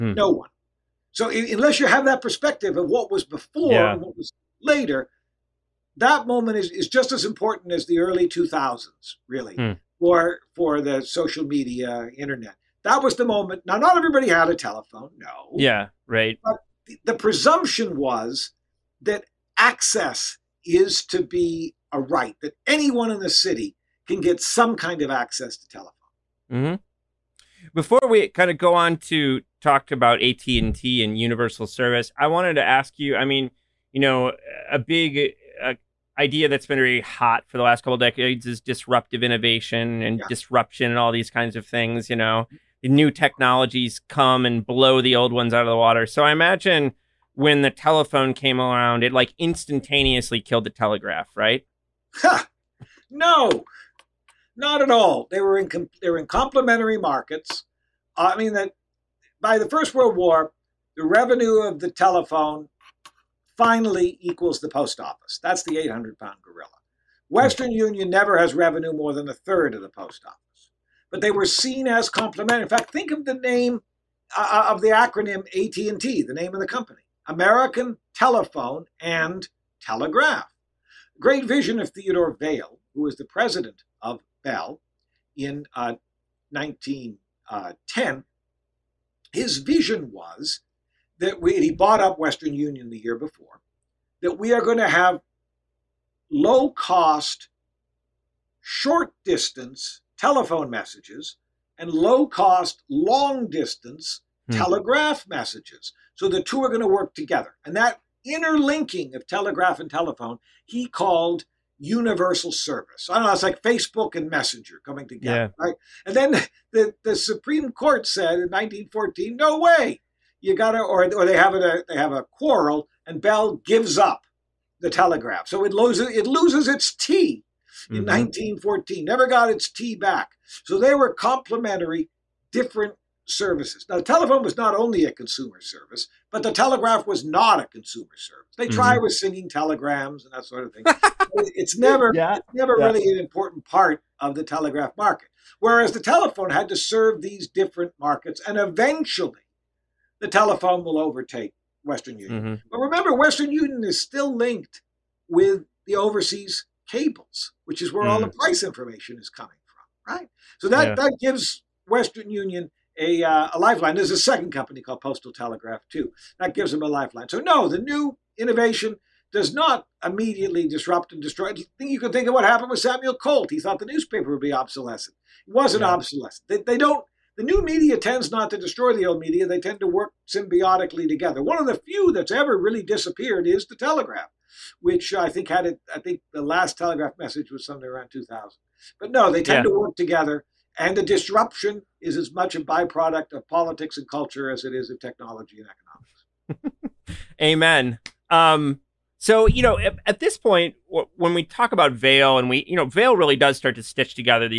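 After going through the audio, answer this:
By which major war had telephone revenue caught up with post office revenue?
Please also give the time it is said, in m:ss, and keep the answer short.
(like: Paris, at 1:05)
First World War, at 0:59.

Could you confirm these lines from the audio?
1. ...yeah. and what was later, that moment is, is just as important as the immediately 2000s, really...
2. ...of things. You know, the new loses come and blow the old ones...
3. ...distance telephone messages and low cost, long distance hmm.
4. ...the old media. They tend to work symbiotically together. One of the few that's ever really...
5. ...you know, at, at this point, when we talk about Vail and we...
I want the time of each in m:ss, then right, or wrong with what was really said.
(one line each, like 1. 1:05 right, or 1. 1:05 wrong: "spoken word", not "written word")
1. 0:03 wrong: "early", not "immediately"
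2. 0:41 wrong: "technologies", not "loses"
3. 1:39 right
4. 2:58 right
5. 3:19 right.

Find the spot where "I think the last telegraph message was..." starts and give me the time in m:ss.
3:05.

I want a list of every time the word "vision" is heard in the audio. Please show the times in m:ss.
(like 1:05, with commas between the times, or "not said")
1:21, 1:29.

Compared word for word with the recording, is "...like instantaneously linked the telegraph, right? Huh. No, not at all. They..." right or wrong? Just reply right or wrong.
wrong.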